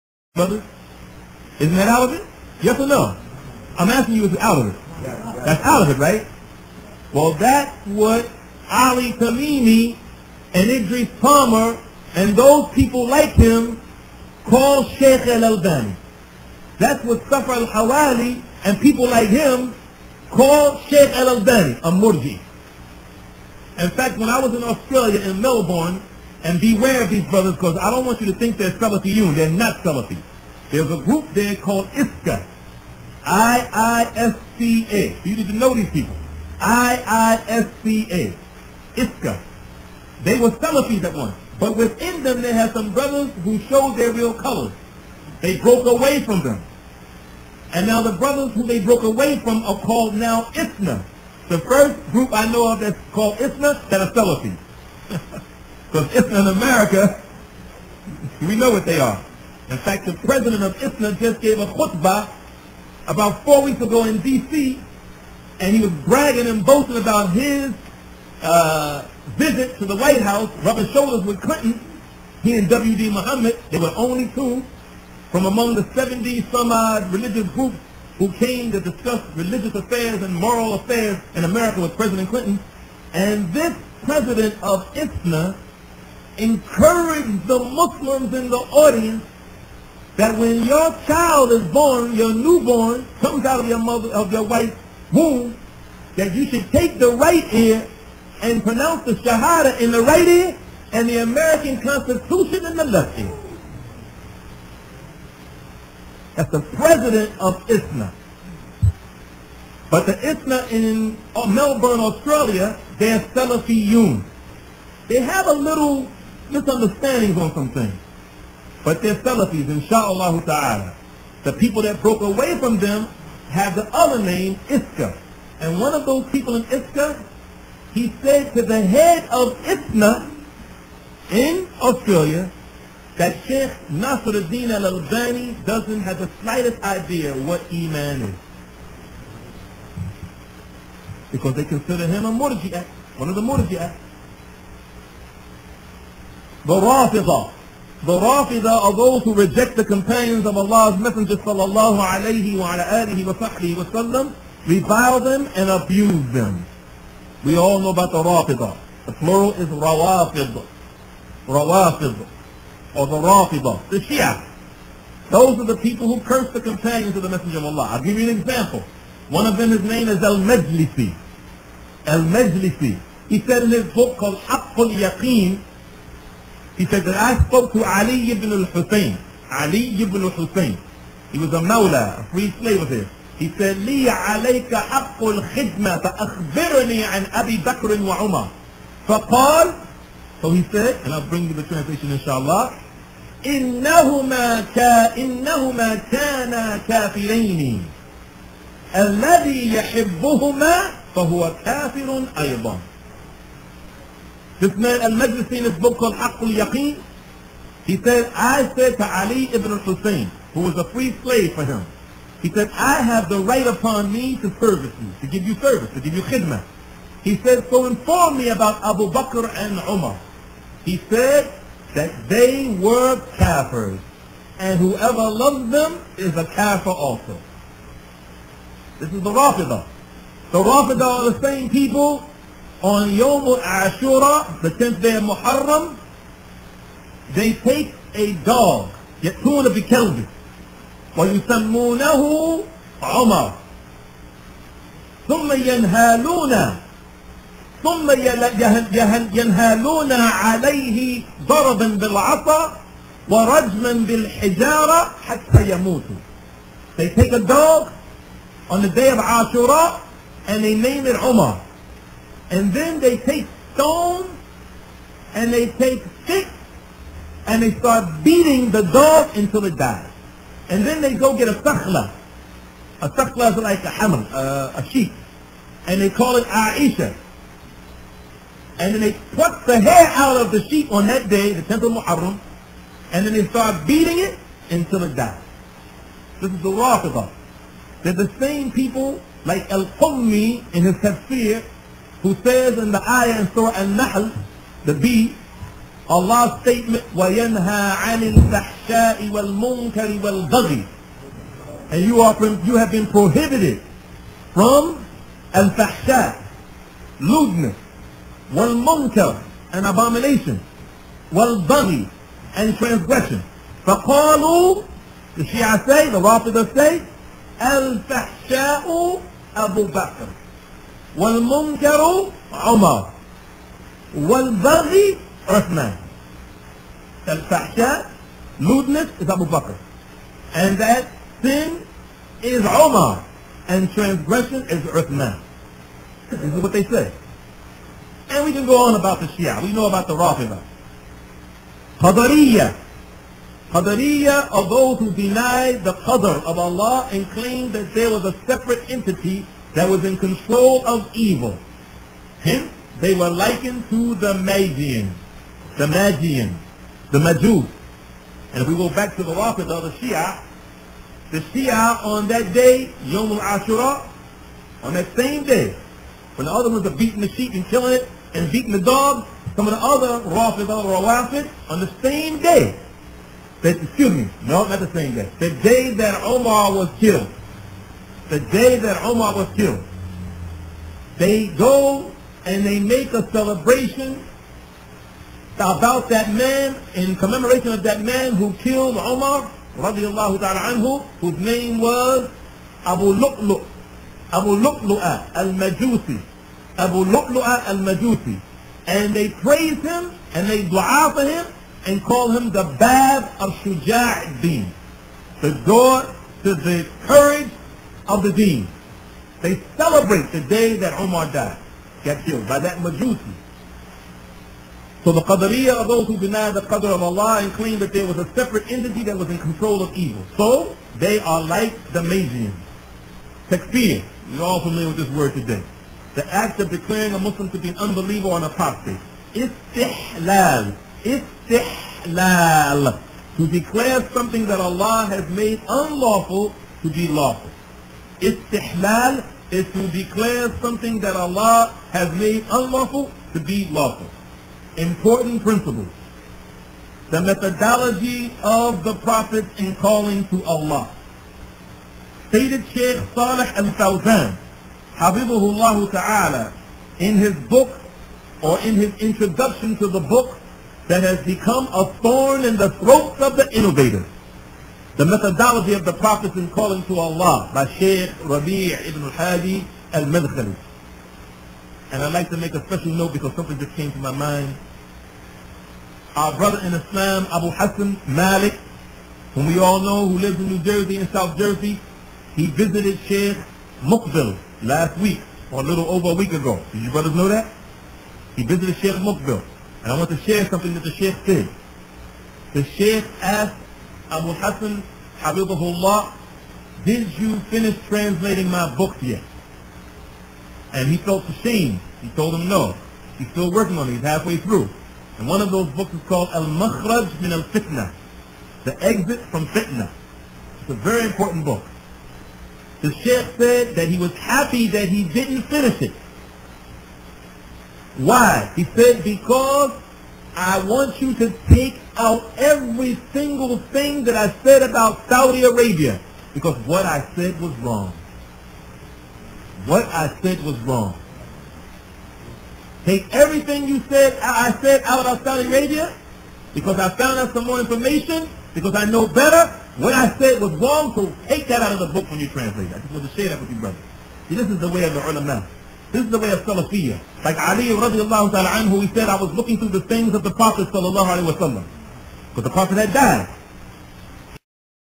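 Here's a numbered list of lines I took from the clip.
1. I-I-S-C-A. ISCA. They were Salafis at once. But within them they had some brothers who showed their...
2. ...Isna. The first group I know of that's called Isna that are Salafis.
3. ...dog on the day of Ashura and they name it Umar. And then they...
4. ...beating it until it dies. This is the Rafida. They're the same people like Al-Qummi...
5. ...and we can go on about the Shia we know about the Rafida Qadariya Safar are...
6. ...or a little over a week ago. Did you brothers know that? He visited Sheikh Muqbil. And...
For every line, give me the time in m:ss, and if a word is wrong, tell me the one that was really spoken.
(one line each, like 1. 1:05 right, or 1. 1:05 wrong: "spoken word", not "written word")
1. 0:36 right
2. 0:50 right
3. 4:17 right
4. 4:43 right
5. 5:38 wrong: "Qadariya", not "Safar"
6. 8:05 right.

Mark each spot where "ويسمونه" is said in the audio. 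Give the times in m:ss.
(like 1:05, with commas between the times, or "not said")
4:01.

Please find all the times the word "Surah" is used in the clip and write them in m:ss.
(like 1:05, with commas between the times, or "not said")
4:53.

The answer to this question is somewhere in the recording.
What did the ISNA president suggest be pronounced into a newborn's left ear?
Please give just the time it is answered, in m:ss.
1:41.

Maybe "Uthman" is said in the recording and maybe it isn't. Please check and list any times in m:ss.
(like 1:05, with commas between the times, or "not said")
5:34.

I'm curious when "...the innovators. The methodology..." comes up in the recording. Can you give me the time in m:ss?
7:43.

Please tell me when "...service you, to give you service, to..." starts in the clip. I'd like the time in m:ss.
3:34.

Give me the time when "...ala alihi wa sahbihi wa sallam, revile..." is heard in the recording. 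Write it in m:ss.
2:32.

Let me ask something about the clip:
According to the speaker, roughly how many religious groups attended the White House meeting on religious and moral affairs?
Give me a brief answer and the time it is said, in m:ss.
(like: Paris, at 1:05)
70, at 1:15.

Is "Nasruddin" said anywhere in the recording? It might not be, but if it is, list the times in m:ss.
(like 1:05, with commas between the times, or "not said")
2:13.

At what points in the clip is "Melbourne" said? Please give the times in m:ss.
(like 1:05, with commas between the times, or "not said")
0:25, 1:51.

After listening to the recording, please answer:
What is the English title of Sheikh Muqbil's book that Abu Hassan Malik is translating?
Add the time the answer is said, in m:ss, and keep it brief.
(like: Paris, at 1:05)
The Exit from Fitna, at 8:28.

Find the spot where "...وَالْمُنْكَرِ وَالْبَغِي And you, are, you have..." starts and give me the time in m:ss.
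4:59.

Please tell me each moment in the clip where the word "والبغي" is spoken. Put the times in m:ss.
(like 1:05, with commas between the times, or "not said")
5:00, 5:24.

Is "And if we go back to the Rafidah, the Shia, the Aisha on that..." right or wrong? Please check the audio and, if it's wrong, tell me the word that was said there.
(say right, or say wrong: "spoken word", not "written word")
wrong: "Shia", not "Aisha".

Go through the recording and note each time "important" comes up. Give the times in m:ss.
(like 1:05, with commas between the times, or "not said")
7:24, 8:31.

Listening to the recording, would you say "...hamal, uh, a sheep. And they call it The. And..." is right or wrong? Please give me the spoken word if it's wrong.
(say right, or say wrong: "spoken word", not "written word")
wrong: "Aisha", not "The".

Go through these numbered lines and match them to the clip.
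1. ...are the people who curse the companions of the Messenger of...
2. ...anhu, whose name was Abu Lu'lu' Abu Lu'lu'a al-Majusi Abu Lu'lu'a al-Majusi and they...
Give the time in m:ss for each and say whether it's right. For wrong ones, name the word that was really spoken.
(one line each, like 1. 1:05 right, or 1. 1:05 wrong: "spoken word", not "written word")
1. 2:45 right
2. 6:30 right.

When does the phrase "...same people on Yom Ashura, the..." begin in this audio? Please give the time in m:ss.
3:51.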